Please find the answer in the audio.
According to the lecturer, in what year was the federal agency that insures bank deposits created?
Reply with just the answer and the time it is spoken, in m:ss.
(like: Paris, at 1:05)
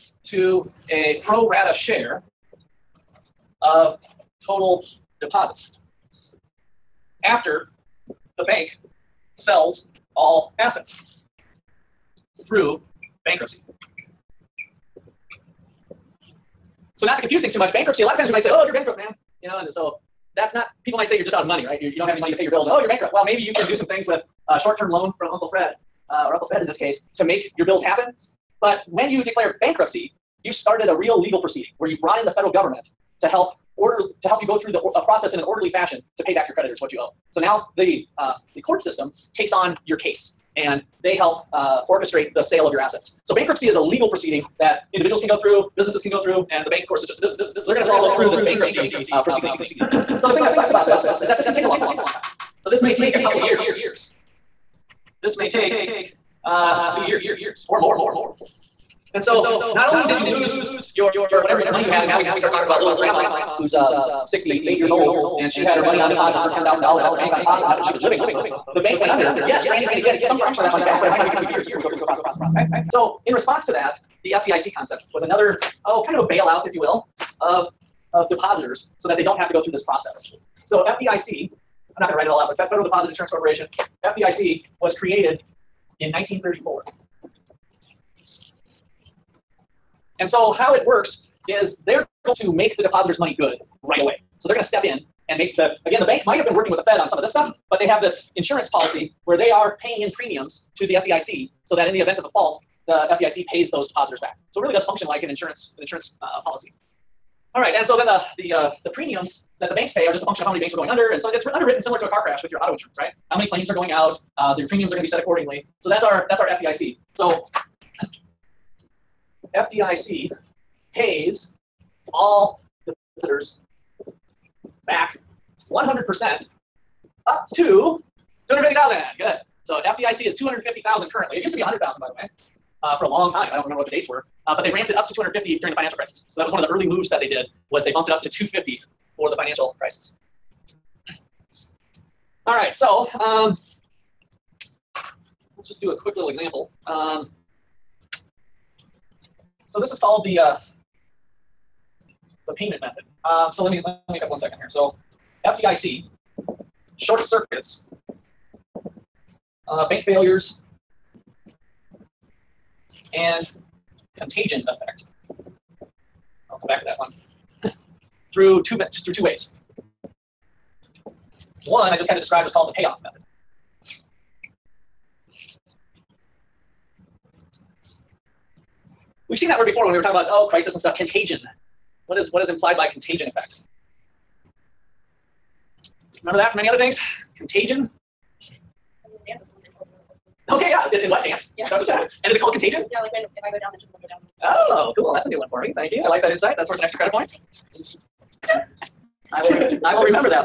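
1934, at 1:26.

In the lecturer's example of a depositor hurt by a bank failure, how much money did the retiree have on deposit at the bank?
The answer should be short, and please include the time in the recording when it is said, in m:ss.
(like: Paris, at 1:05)
$10,000, at 1:06.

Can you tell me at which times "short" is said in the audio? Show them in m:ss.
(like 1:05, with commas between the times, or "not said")
0:24, 2:36.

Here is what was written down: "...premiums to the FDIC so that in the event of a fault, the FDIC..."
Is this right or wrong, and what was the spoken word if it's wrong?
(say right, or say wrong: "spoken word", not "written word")
right.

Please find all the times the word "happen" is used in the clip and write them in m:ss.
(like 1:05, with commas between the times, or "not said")
0:27.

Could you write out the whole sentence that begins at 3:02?
What is, what is implied by contagion effect?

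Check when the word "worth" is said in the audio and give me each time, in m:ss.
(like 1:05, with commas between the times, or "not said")
3:16.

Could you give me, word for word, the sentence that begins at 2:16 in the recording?
So that was one of the early moves that they did was they bumped it up to 250 for the financial crisis.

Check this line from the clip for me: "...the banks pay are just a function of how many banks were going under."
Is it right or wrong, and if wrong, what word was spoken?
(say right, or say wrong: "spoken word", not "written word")
right.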